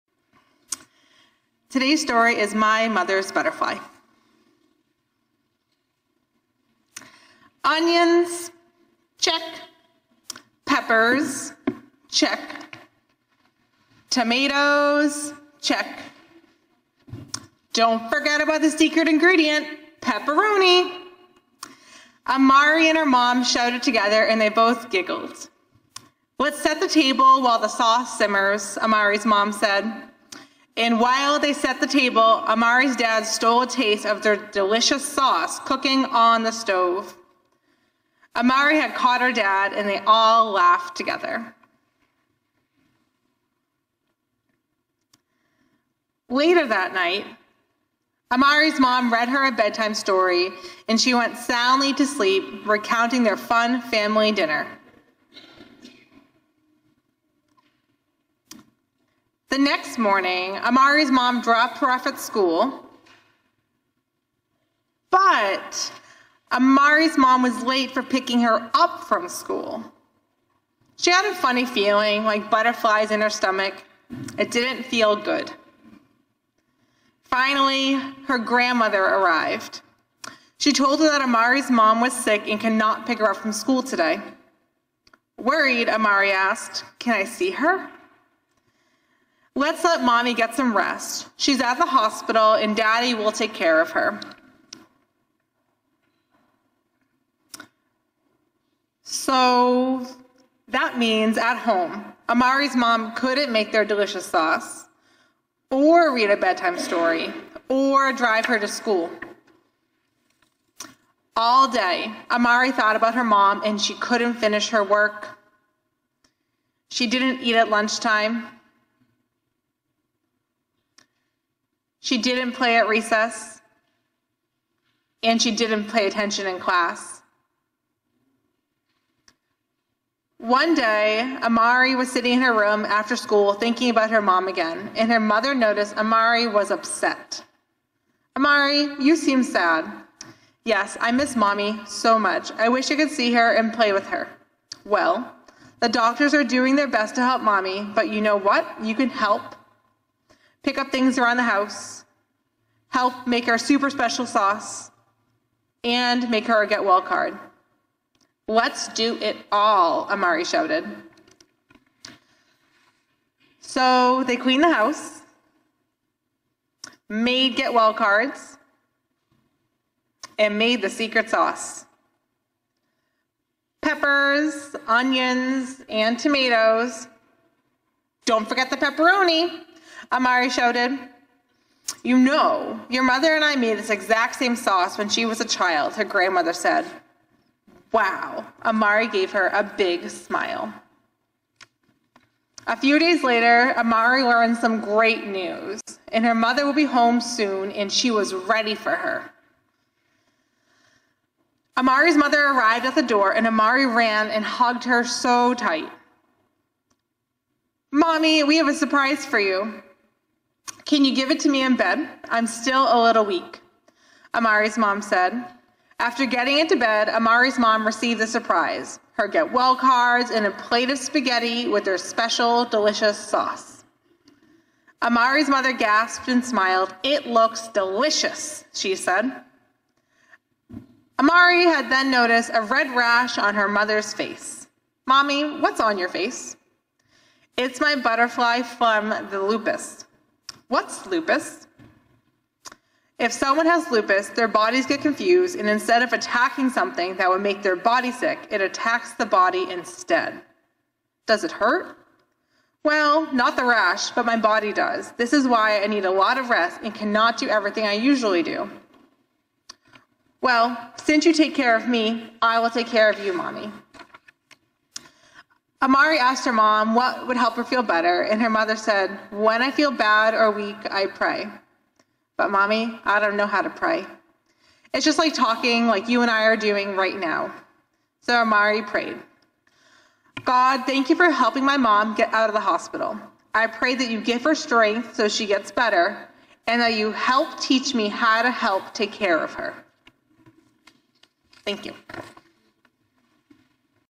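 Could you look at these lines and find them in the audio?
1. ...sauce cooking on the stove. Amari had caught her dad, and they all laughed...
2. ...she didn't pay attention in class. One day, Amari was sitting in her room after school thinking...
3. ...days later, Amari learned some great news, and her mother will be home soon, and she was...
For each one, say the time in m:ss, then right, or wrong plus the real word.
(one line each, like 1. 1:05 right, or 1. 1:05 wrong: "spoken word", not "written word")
1. 0:35 right
2. 2:05 right
3. 3:12 right.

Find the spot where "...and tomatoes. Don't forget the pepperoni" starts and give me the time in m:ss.
2:55.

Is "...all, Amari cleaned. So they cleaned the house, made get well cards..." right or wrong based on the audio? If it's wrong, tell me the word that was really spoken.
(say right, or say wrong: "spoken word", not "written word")
wrong: "shouted", not "cleaned".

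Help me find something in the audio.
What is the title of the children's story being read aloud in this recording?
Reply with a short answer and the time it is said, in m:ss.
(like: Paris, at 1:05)
My Mother's Butterfly, at 0:02.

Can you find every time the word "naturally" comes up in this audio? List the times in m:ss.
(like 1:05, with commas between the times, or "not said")
not said.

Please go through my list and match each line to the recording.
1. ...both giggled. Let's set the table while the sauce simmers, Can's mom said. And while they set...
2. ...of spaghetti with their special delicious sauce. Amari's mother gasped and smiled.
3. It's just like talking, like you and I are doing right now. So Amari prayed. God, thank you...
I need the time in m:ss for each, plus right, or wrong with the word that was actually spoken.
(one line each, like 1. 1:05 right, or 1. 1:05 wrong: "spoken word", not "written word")
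1. 0:24 wrong: "Amari", not "Can"
2. 3:40 right
3. 4:34 right.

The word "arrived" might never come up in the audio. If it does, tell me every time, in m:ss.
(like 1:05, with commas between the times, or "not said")
1:19, 3:22.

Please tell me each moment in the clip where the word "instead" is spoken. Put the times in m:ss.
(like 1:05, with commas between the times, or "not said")
4:05, 4:09.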